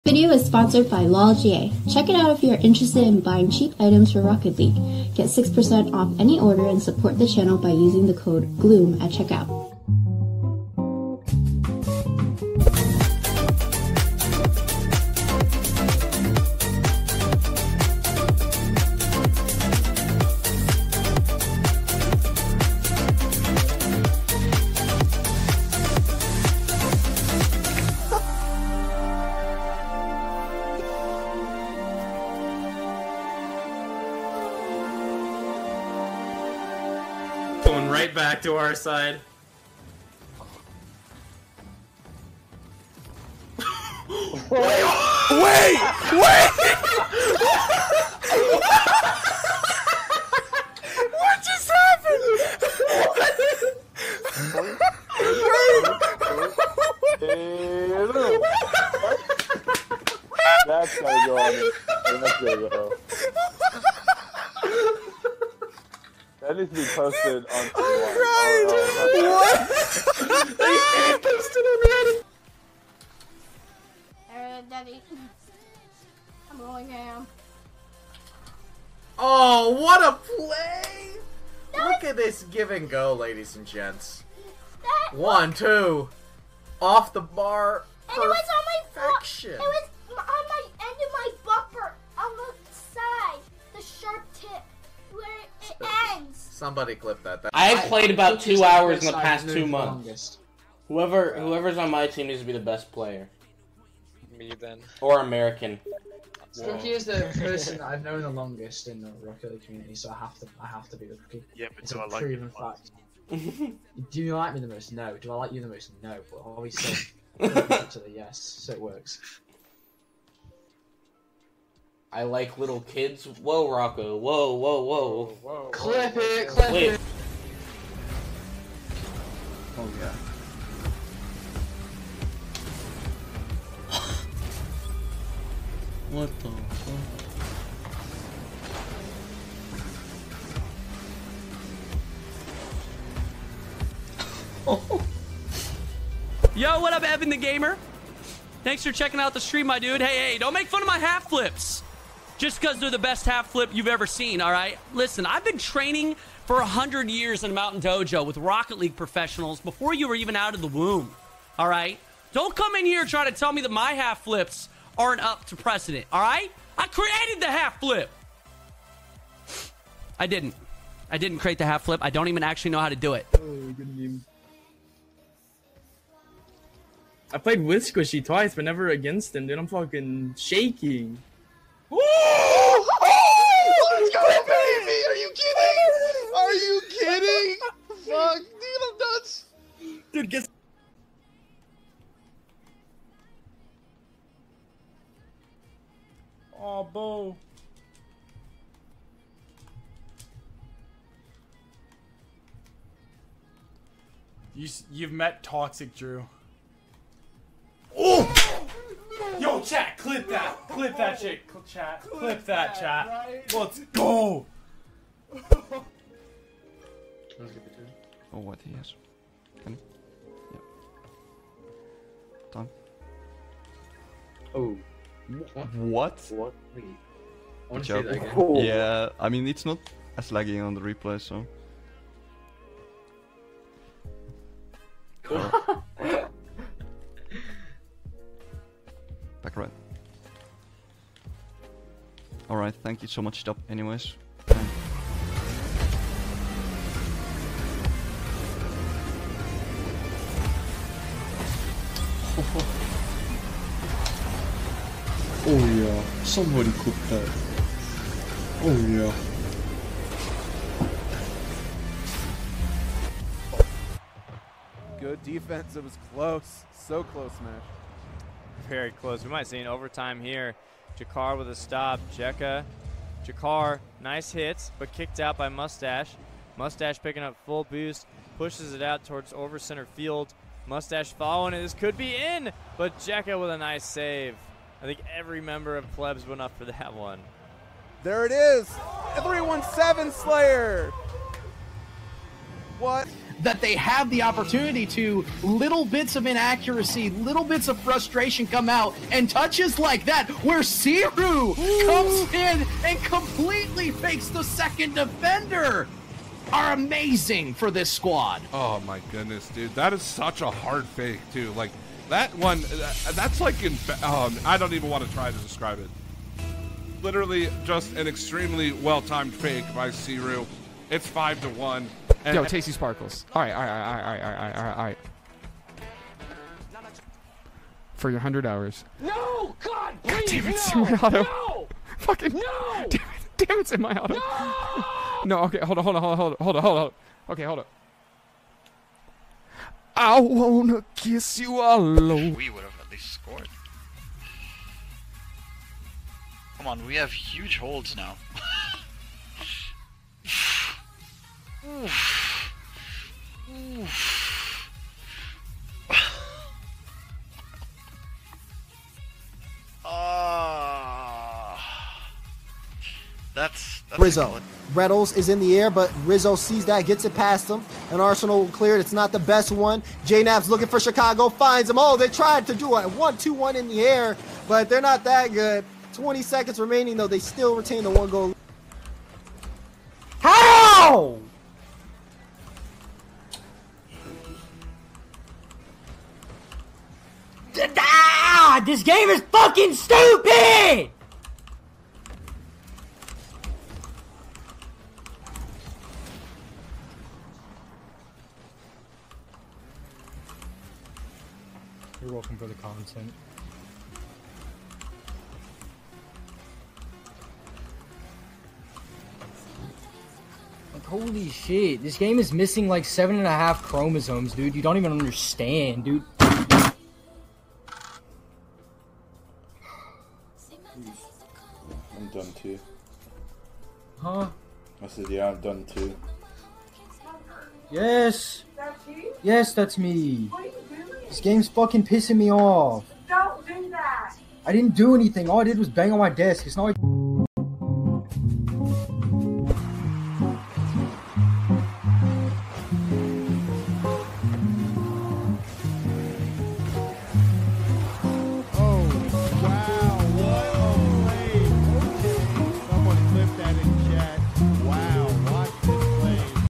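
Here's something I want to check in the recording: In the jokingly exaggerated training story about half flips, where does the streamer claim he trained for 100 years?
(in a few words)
Mountain Dojo.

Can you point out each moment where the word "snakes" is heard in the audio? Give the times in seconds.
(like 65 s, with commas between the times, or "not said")
not said.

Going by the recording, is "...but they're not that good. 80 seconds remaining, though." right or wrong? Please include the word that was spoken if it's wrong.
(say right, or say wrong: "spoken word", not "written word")
wrong: "20", not "80".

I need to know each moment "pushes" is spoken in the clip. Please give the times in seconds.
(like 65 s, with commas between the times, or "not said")
278 s.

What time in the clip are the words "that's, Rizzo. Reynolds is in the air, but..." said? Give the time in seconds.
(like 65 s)
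363 s.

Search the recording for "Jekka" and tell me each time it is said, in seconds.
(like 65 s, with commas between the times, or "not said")
272 s, 282 s.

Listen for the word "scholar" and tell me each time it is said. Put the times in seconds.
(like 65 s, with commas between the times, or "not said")
not said.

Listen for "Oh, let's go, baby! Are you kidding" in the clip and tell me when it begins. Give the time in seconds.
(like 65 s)
181 s.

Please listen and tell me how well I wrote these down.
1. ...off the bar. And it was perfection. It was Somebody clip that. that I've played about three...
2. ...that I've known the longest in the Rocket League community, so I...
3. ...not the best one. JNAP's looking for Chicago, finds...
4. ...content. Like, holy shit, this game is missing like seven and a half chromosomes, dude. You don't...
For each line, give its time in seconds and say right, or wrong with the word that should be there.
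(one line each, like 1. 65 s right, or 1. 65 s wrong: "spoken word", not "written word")
1. 86 s wrong: "two", not "three"
2. 107 s right
3. 368 s right
4. 402 s right.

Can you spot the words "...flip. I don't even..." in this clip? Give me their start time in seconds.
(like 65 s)
171 s.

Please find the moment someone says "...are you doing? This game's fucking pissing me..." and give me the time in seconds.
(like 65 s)
430 s.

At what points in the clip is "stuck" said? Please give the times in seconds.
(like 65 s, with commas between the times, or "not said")
not said.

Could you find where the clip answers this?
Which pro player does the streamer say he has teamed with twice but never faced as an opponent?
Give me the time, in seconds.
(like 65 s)
177 s.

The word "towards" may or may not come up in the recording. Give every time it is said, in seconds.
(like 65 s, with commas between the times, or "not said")
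279 s.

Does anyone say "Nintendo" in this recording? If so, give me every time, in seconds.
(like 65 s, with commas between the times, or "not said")
not said.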